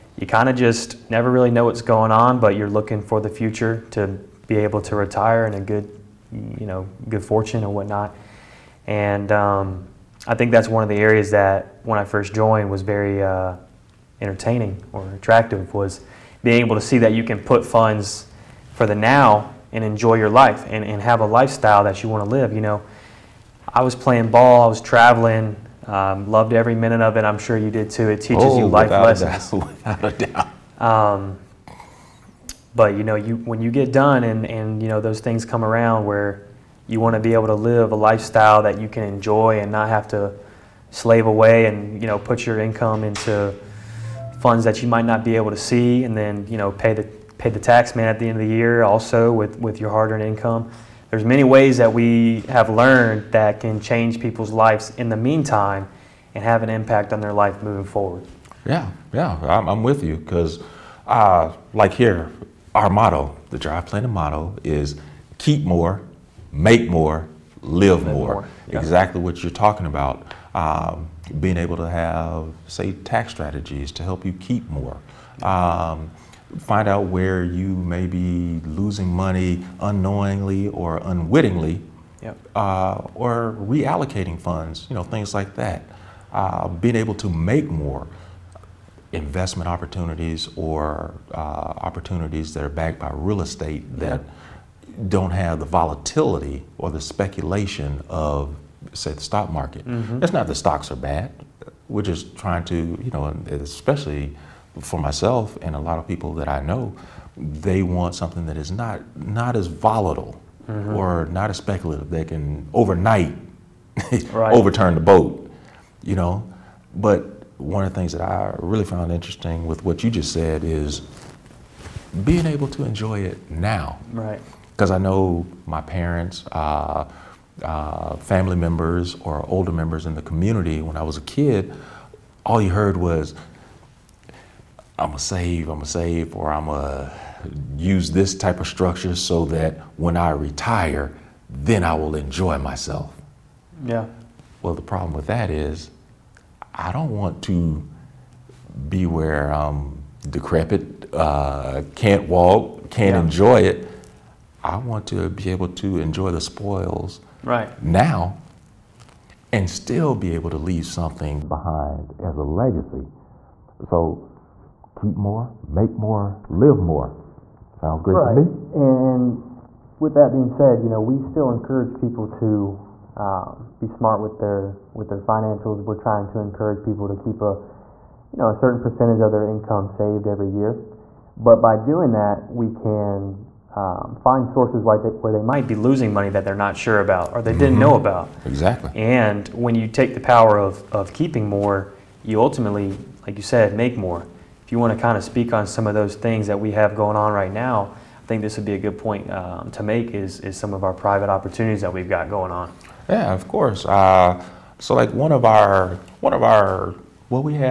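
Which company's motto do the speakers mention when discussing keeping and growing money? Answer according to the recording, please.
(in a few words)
Drive Planning.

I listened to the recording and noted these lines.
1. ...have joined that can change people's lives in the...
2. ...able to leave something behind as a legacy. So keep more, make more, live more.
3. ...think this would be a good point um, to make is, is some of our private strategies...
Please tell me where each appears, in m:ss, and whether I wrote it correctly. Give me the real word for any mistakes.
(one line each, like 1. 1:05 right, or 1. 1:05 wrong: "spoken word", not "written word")
1. 0:52 wrong: "learned", not "joined"
2. 2:40 right
3. 3:18 wrong: "opportunities", not "strategies".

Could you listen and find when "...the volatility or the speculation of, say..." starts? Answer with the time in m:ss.
1:35.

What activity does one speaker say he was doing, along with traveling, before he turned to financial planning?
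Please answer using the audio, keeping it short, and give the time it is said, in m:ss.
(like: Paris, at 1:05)
Playing ball, at 0:23.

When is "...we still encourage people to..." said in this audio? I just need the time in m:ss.
2:51.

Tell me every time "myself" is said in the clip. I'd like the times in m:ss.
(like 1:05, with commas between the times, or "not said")
1:45, 2:22.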